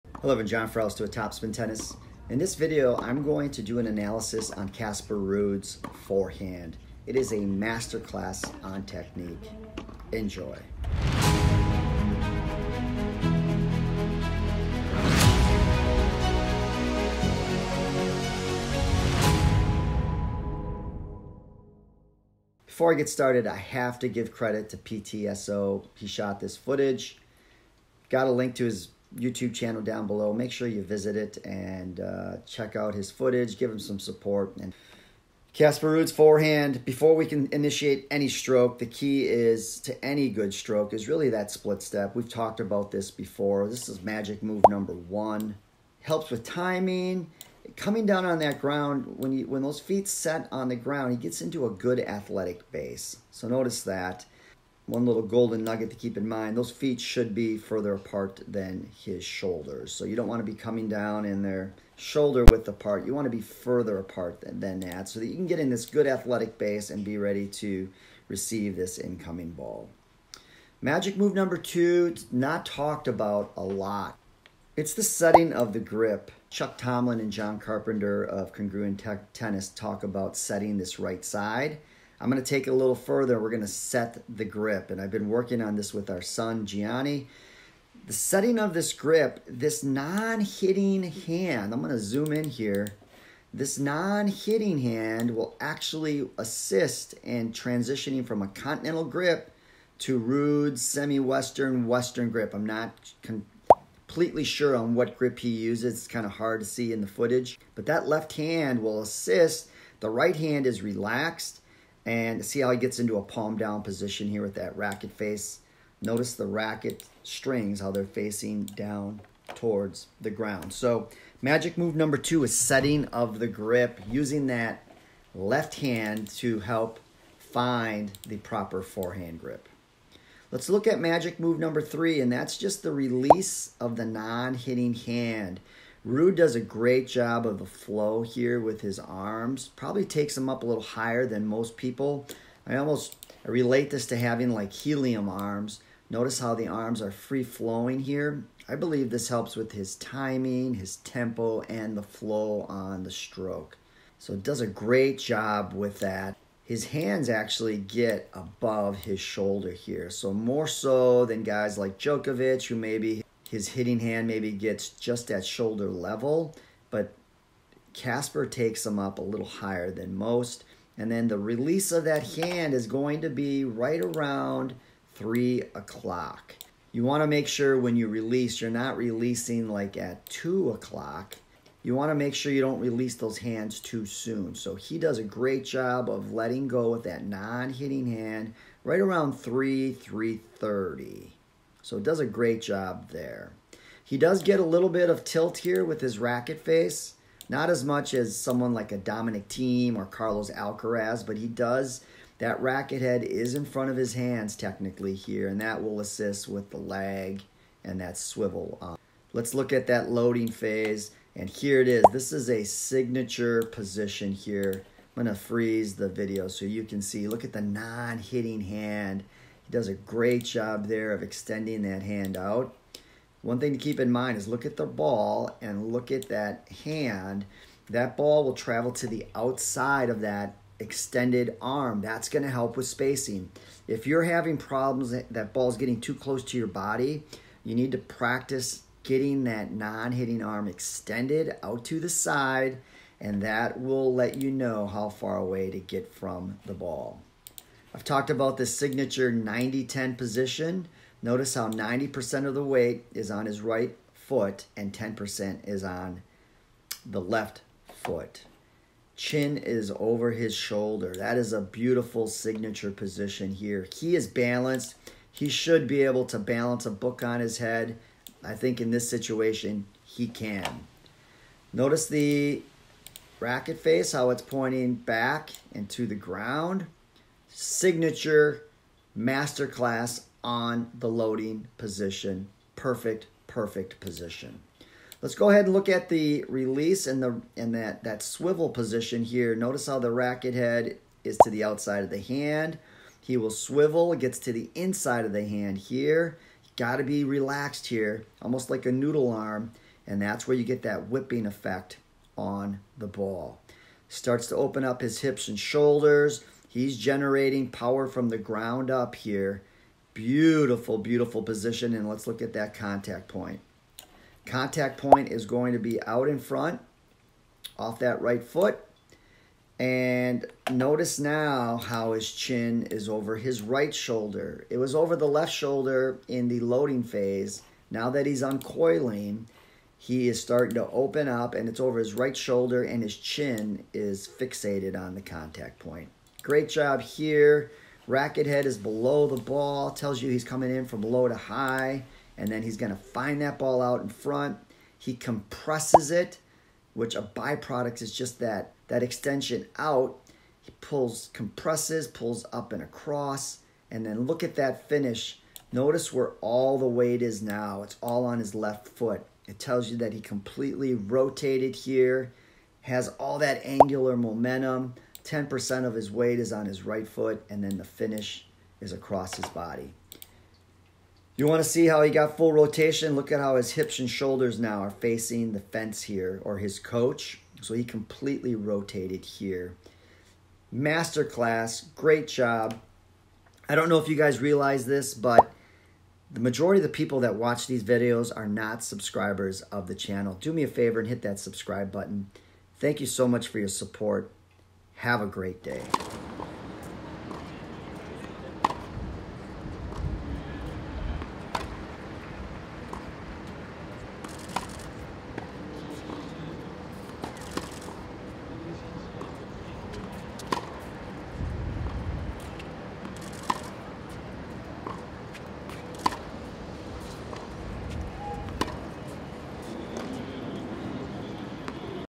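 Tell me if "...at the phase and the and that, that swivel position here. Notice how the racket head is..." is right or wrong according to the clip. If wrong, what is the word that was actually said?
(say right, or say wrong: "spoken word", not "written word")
wrong: "release", not "phase".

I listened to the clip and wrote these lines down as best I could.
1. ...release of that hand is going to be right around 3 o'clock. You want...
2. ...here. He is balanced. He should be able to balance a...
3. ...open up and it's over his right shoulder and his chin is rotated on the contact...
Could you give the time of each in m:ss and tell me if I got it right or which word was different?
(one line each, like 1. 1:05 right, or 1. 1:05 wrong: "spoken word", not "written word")
1. 2:51 right
2. 4:23 right
3. 5:30 wrong: "fixated", not "rotated".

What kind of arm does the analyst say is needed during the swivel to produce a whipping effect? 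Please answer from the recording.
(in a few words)
noodle arm.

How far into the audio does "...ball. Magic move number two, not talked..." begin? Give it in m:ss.
1:09.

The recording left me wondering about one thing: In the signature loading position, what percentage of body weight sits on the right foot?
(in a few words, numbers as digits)
90%.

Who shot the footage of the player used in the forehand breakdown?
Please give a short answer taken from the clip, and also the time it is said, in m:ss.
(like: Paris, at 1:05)
PTSO, at 0:24.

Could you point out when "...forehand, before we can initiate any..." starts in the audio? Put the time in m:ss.
0:36.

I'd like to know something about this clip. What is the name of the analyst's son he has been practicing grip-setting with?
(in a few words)
Gianni.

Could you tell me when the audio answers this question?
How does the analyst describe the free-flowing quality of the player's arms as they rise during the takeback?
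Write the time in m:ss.
2:24.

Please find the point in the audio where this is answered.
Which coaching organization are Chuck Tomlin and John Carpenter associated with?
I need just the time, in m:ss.
1:18.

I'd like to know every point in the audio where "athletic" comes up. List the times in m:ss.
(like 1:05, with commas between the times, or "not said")
0:51, 1:06.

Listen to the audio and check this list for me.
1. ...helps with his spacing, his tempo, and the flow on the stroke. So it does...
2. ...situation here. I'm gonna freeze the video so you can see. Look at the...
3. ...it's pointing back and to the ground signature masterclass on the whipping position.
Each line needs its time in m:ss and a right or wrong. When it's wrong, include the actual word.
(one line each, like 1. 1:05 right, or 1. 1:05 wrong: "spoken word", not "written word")
1. 2:29 wrong: "timing", not "spacing"
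2. 3:33 wrong: "position", not "situation"
3. 4:34 wrong: "loading", not "whipping".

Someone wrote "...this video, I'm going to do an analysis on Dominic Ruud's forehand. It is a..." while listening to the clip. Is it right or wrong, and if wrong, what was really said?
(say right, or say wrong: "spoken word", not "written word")
wrong: "Casper", not "Dominic".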